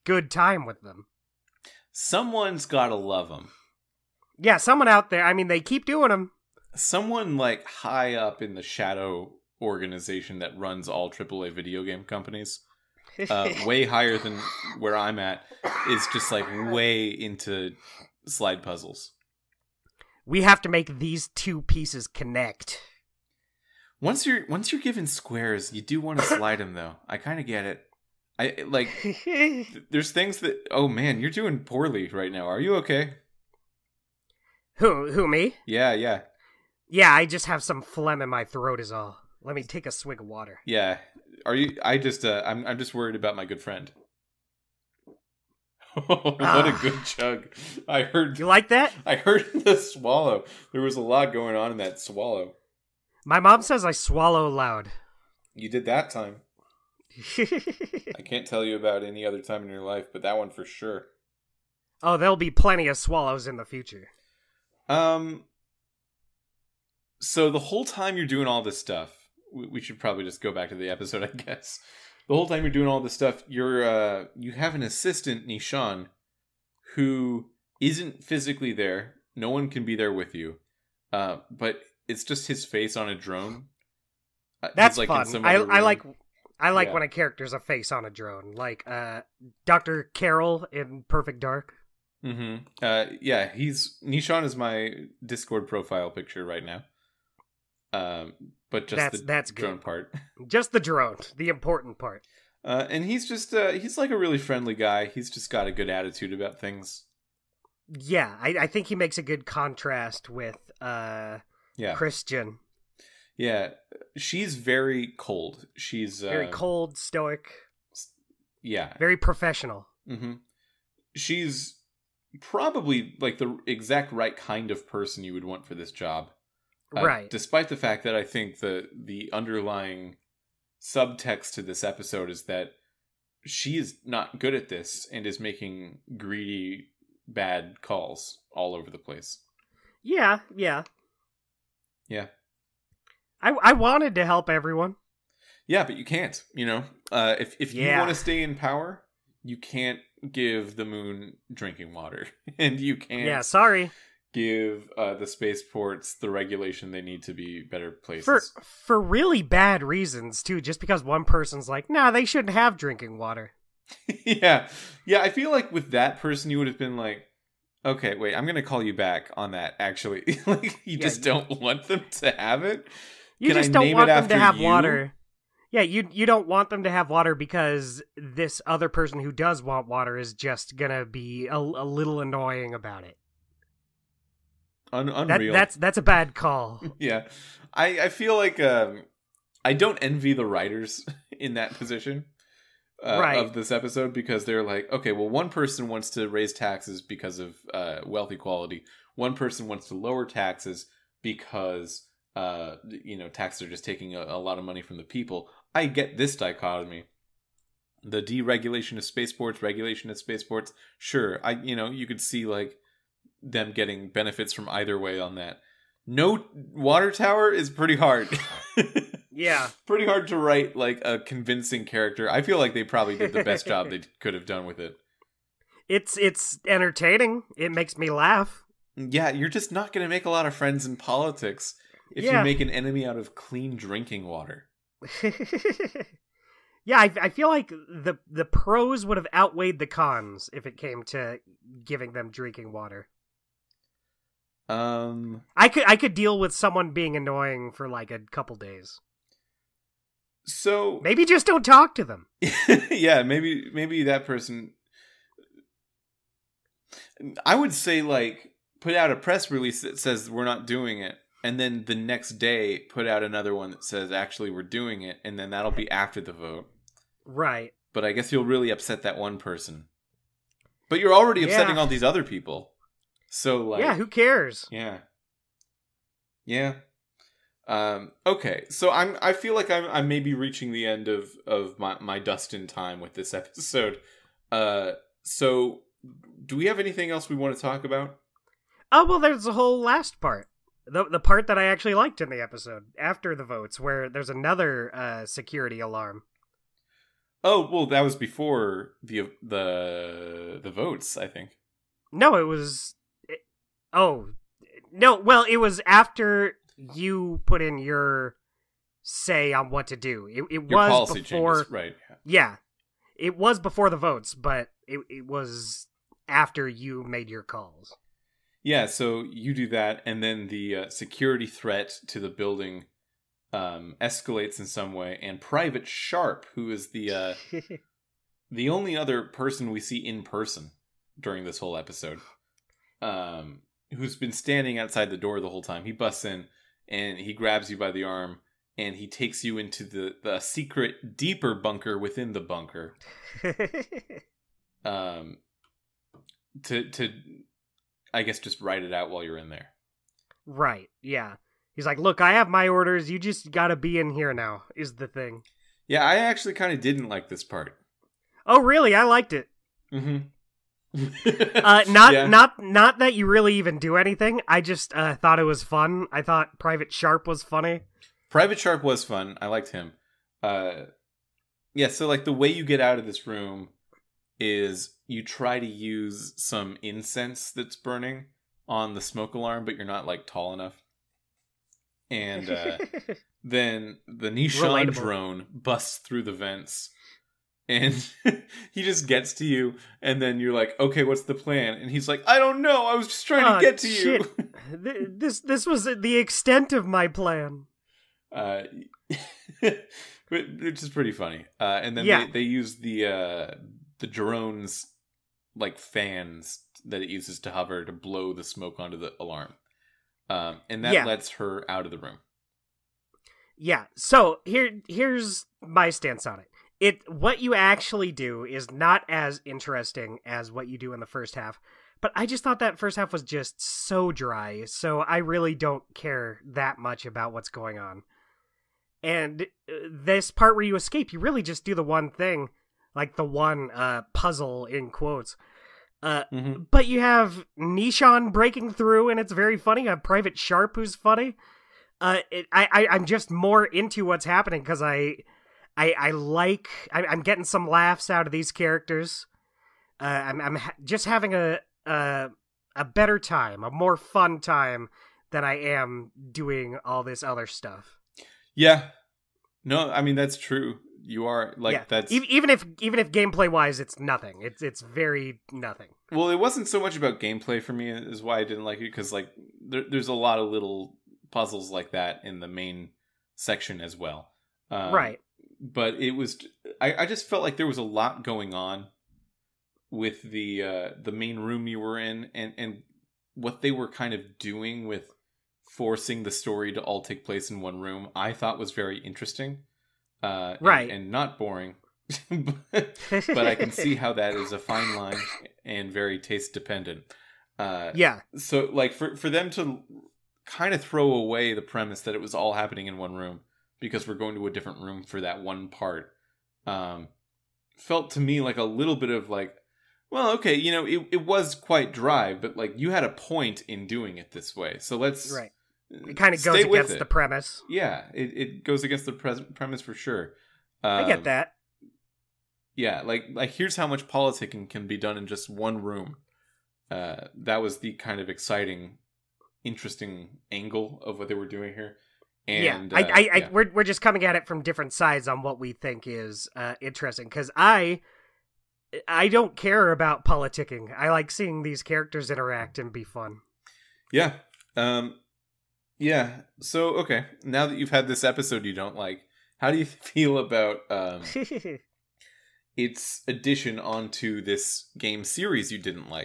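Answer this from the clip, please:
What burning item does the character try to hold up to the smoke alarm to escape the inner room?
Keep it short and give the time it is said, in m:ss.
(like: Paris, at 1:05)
incense, at 6:16.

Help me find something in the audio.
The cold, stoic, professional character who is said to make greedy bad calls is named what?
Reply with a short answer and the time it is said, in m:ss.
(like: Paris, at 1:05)
Chrisjen, at 1:51.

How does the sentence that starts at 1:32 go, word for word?
hmm Uh, yeah, he's Nishan is my Discord profile picture right now.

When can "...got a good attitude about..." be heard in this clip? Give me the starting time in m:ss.
1:45.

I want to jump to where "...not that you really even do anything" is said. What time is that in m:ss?
6:02.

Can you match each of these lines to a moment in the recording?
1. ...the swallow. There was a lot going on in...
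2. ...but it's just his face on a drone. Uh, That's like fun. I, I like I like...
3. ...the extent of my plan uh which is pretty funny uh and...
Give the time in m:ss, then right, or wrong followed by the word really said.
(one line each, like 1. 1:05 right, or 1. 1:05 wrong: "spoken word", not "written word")
1. 0:49 right
2. 1:21 right
3. 6:35 right.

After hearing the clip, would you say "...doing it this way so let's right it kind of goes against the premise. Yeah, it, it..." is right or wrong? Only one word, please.
right.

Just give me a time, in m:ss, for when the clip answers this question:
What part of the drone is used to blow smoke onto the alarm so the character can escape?
6:45.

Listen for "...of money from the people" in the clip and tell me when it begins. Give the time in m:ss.
3:24.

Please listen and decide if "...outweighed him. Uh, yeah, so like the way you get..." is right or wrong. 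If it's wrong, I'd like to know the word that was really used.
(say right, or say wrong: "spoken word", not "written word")
wrong: "liked", not "outweighed".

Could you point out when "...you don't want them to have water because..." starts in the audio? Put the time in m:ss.
2:56.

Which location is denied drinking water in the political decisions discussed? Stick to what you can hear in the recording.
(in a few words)
the moon.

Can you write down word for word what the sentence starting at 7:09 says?
And uh, this part where you escape, you really just do the one thing like the one uh, puzzle in quotes.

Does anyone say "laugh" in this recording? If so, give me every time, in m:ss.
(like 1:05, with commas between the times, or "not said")
3:48, 7:27.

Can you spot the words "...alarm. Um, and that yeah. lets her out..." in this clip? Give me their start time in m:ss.
6:49.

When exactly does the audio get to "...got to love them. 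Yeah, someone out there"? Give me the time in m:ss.
0:02.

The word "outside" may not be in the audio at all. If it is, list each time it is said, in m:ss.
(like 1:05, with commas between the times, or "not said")
5:34.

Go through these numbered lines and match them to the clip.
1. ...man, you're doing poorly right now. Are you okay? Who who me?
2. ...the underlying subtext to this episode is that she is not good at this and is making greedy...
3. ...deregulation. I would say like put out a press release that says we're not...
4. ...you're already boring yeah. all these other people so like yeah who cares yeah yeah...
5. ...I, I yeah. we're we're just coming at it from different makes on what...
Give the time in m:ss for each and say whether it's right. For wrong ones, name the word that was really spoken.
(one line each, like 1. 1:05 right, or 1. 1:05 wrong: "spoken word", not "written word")
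1. 0:30 right
2. 2:08 right
3. 4:14 wrong: "person", not "deregulation"
4. 4:30 wrong: "upsetting", not "boring"
5. 8:53 wrong: "sides", not "makes".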